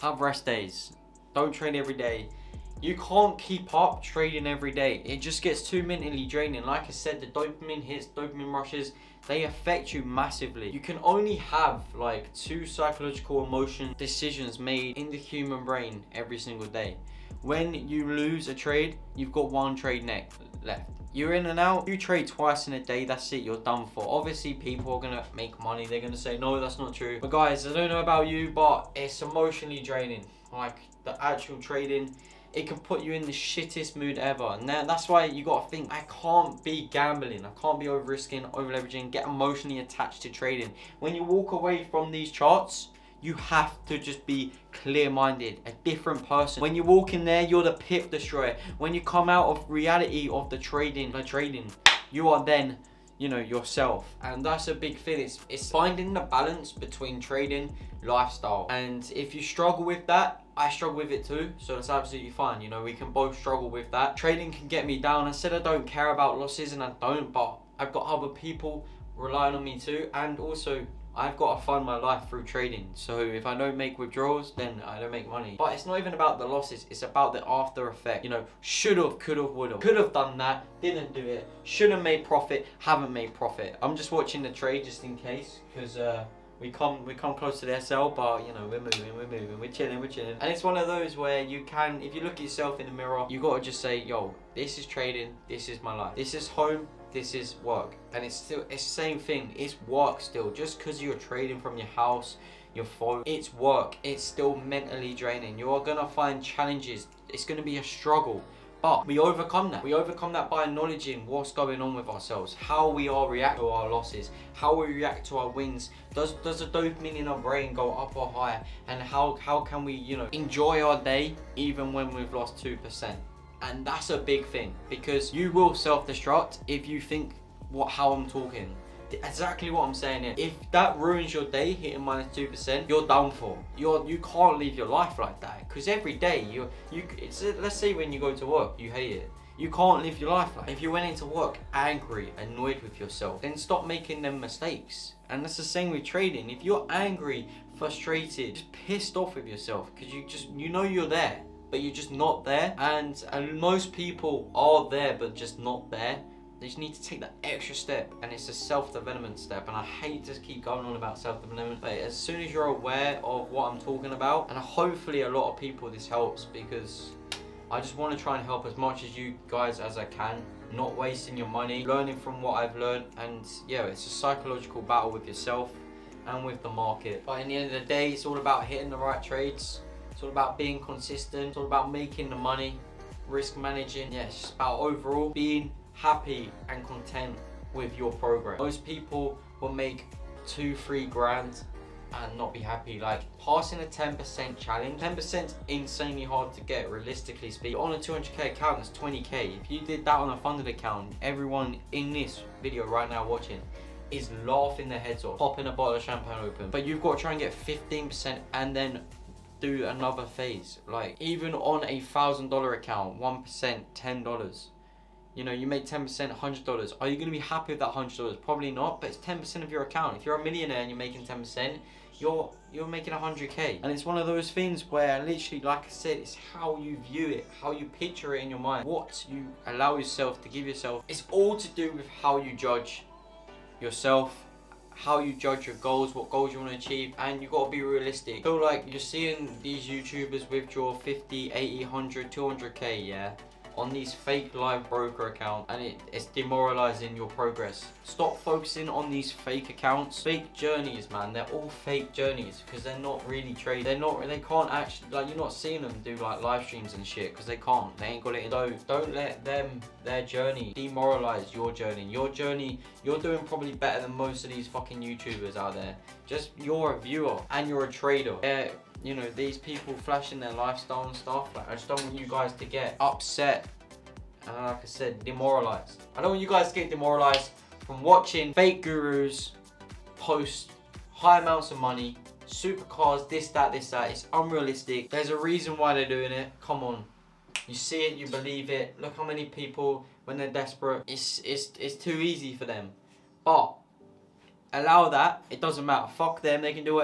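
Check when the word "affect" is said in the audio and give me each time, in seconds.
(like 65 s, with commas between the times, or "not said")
9 s.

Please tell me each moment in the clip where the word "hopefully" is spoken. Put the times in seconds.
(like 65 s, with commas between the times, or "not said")
164 s.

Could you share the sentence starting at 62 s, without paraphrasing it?
You know, we can both struggle with that.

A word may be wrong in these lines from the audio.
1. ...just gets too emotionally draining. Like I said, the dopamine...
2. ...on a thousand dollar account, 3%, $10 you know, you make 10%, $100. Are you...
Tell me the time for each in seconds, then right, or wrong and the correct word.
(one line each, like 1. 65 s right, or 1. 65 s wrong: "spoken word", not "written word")
1. 5 s wrong: "mentally", not "emotionally"
2. 211 s wrong: "1", not "3".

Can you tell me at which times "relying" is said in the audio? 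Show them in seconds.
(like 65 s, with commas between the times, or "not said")
69 s.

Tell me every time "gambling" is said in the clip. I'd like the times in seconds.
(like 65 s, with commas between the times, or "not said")
36 s.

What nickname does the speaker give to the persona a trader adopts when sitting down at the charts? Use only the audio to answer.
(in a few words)
the pip destroyer.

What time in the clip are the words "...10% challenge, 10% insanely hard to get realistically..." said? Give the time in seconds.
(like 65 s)
193 s.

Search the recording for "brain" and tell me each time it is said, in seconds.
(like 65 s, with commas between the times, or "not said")
15 s, 117 s.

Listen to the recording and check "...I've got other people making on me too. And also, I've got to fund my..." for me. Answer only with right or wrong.
wrong.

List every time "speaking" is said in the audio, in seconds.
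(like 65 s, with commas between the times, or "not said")
197 s.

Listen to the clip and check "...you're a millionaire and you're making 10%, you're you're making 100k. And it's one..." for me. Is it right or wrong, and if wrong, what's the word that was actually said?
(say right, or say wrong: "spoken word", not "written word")
right.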